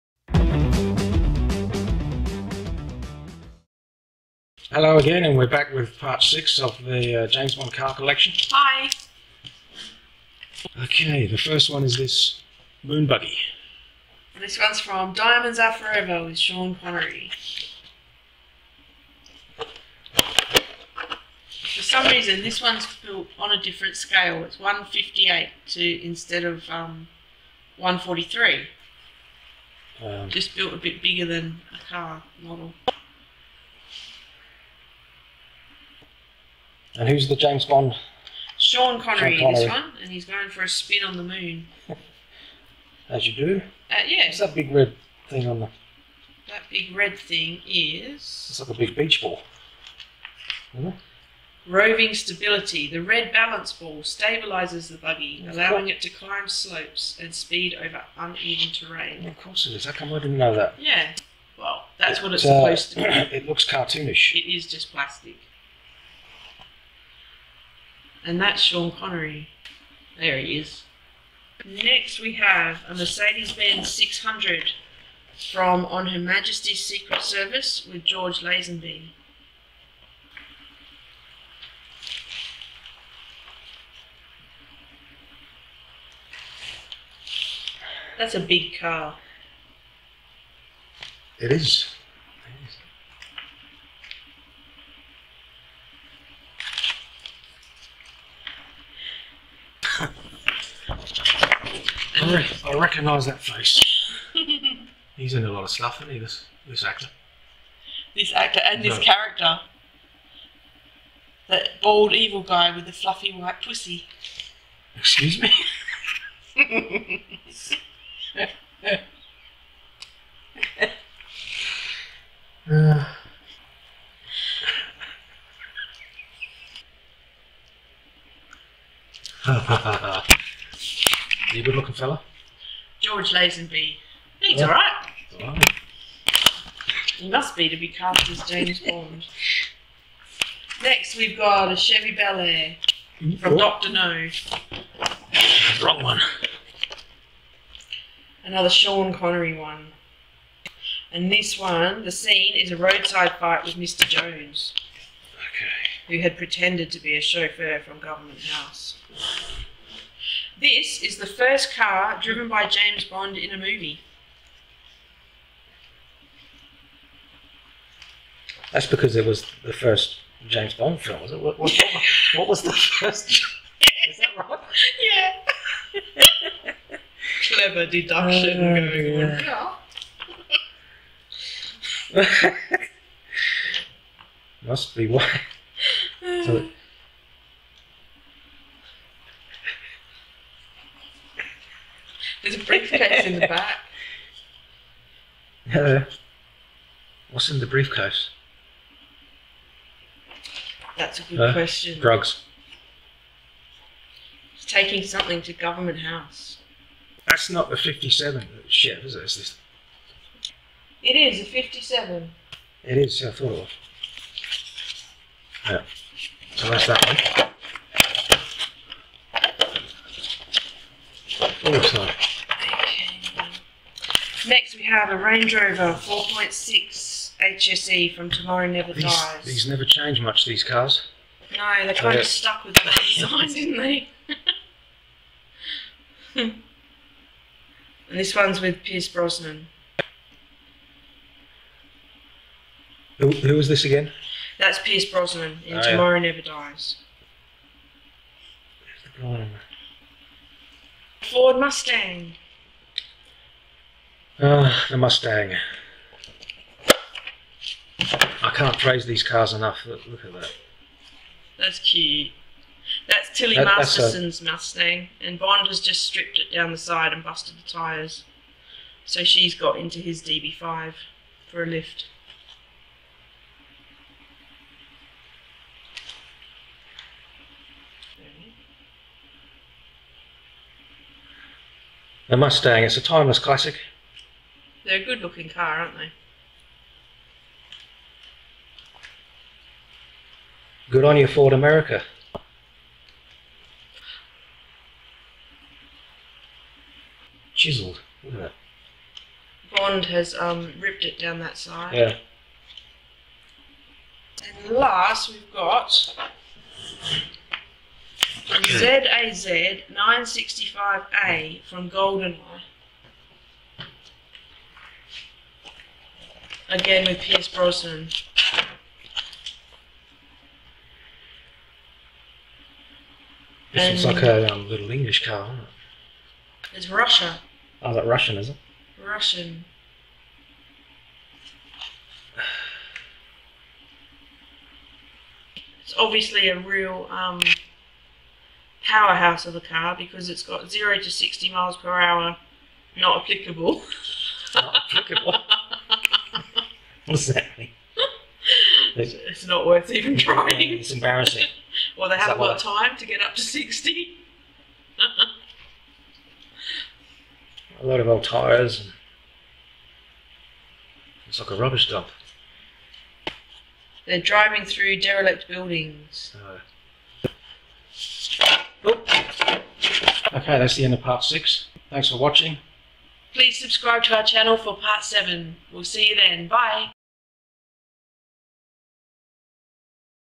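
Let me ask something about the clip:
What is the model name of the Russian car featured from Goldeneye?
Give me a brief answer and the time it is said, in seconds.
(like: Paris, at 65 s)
ZAZ 965A, at 308 s.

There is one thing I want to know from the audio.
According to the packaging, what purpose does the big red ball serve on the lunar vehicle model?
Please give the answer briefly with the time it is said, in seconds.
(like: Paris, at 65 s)
Stabilizes the buggy, at 54 s.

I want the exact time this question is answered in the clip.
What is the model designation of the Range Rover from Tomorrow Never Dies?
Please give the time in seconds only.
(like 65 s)
225 s.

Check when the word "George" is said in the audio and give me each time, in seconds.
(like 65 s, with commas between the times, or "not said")
78 s, 133 s.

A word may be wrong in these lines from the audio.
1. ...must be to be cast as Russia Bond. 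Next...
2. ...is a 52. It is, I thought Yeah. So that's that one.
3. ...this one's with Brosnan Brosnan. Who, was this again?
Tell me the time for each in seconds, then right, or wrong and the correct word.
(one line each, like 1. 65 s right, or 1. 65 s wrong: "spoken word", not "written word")
1. 137 s wrong: "James", not "Russia"
2. 211 s wrong: "57", not "52"
3. 238 s wrong: "Pierce", not "Brosnan".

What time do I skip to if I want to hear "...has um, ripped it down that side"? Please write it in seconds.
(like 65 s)
300 s.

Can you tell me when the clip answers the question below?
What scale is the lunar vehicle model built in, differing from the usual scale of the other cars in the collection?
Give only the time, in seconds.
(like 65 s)
24 s.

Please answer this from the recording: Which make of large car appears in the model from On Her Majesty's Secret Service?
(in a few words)
Mercedes Benz 600.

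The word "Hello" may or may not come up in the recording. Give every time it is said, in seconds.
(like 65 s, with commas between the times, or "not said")
4 s, 195 s.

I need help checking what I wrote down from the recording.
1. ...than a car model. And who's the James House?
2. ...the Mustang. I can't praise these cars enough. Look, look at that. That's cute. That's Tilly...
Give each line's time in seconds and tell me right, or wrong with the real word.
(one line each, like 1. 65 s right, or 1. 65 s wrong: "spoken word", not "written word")
1. 31 s wrong: "Bond", not "House"
2. 254 s right.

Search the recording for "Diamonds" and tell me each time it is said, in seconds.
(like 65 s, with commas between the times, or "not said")
15 s.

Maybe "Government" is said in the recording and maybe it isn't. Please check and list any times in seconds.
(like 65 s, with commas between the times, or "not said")
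157 s, 205 s.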